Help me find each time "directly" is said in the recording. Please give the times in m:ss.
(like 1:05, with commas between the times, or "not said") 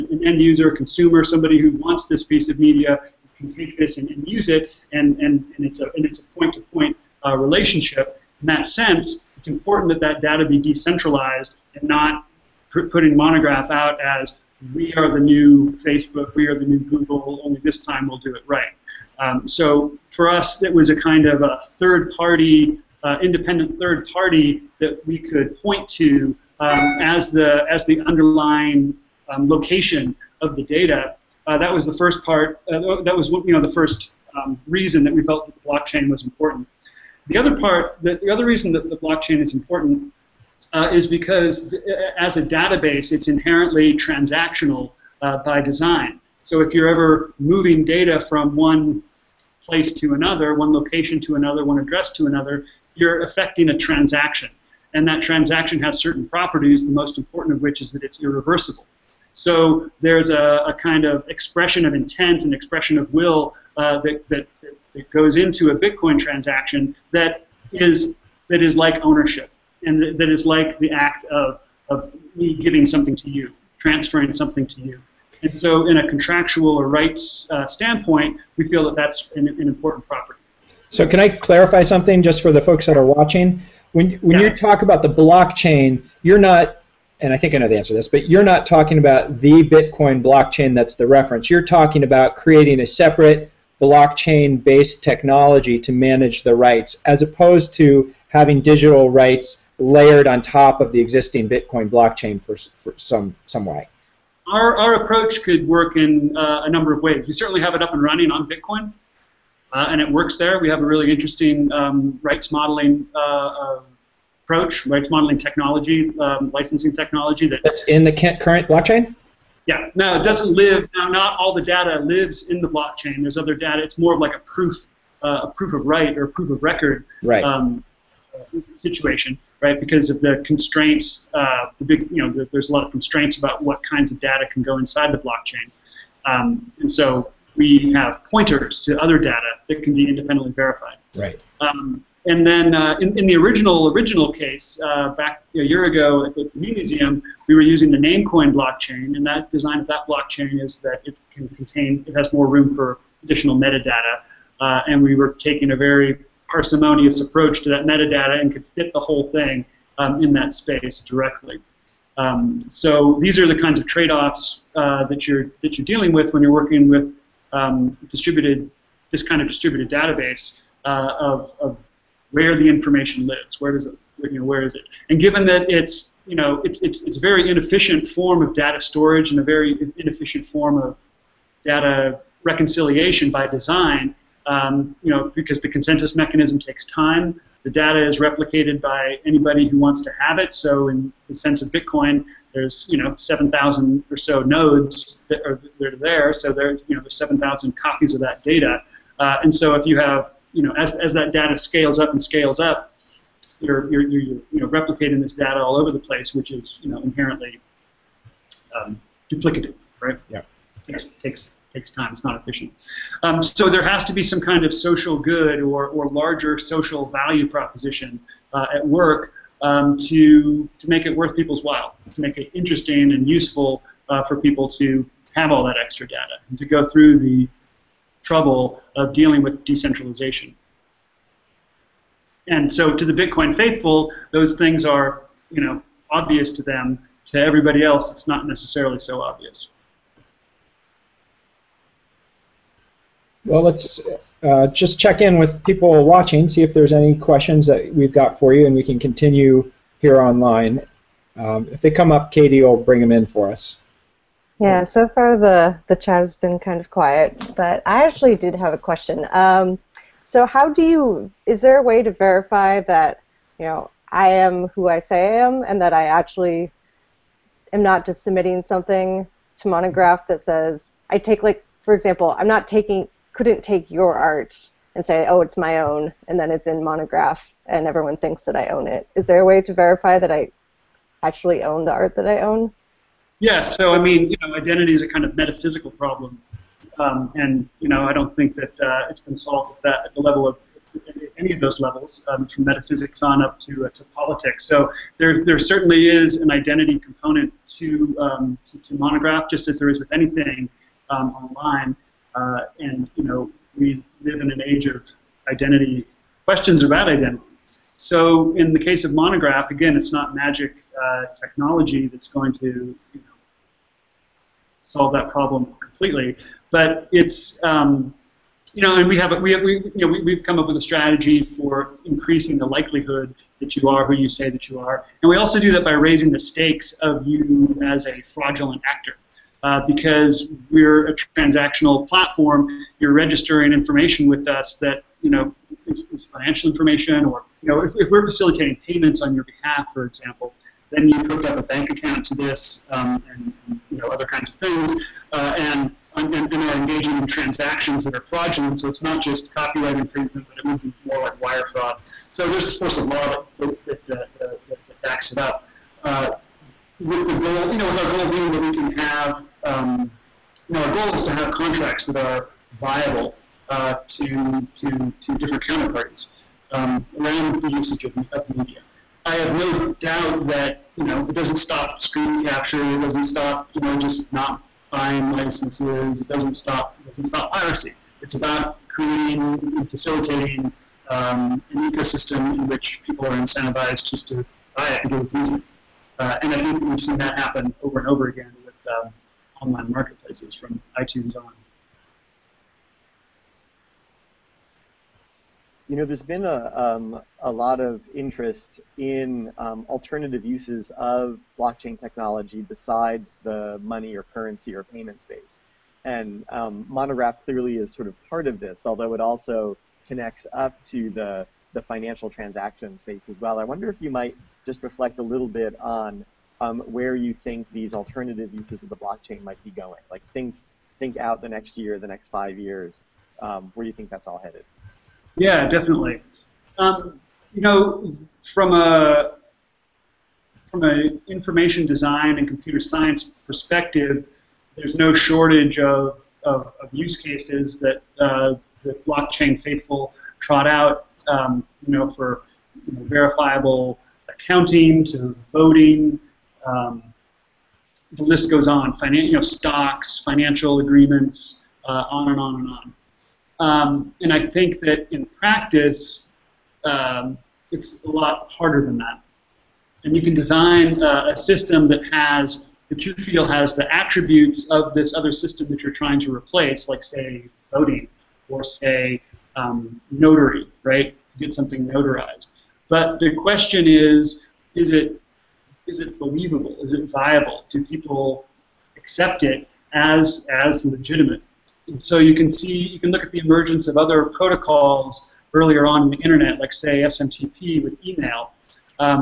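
2:41.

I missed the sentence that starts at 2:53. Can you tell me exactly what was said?
Where does it you know where is it?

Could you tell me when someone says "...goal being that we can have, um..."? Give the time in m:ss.
5:58.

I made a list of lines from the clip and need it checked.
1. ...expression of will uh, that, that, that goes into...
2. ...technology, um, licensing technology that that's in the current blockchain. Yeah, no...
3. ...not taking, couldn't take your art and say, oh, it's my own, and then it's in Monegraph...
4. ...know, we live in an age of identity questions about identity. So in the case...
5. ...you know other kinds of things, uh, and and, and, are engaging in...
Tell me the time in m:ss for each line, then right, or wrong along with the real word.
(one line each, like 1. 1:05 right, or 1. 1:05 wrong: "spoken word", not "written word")
1. 1:02 right
2. 1:55 right
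3. 4:32 right
4. 5:03 right
5. 5:43 right.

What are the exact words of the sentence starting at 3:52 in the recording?
And so to the Bitcoin faithful, those things are, you know, obvious to them.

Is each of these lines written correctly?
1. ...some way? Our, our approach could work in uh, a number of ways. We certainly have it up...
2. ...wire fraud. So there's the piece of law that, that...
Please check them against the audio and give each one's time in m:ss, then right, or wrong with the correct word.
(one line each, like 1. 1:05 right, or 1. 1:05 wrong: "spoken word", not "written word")
1. 1:43 right
2. 5:51 wrong: "force", not "piece".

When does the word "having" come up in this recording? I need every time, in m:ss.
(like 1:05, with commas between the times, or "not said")
1:38.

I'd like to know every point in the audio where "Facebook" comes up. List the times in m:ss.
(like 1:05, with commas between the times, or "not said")
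0:15.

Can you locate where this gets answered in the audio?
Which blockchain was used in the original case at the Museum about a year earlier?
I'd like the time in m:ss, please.
2:27.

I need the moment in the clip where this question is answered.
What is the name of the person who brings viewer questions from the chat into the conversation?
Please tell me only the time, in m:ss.
4:12.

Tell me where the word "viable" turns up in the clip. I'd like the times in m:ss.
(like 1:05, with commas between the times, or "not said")
6:02, 7:57.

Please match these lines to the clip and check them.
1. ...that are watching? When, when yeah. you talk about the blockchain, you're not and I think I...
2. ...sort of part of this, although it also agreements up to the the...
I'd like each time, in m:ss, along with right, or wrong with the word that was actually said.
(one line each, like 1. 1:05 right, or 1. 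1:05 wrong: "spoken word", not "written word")
1. 1:22 right
2. 6:47 wrong: "connects", not "agreements".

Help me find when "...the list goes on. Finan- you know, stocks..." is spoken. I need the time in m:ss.
7:28.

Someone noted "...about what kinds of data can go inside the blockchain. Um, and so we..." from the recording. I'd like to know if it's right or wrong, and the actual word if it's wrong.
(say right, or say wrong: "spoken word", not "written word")
right.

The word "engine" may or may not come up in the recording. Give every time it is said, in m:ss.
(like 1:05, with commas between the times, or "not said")
not said.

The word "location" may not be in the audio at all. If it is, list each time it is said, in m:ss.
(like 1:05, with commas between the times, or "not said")
0:29, 0:50.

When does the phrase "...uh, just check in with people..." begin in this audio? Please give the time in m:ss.
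4:04.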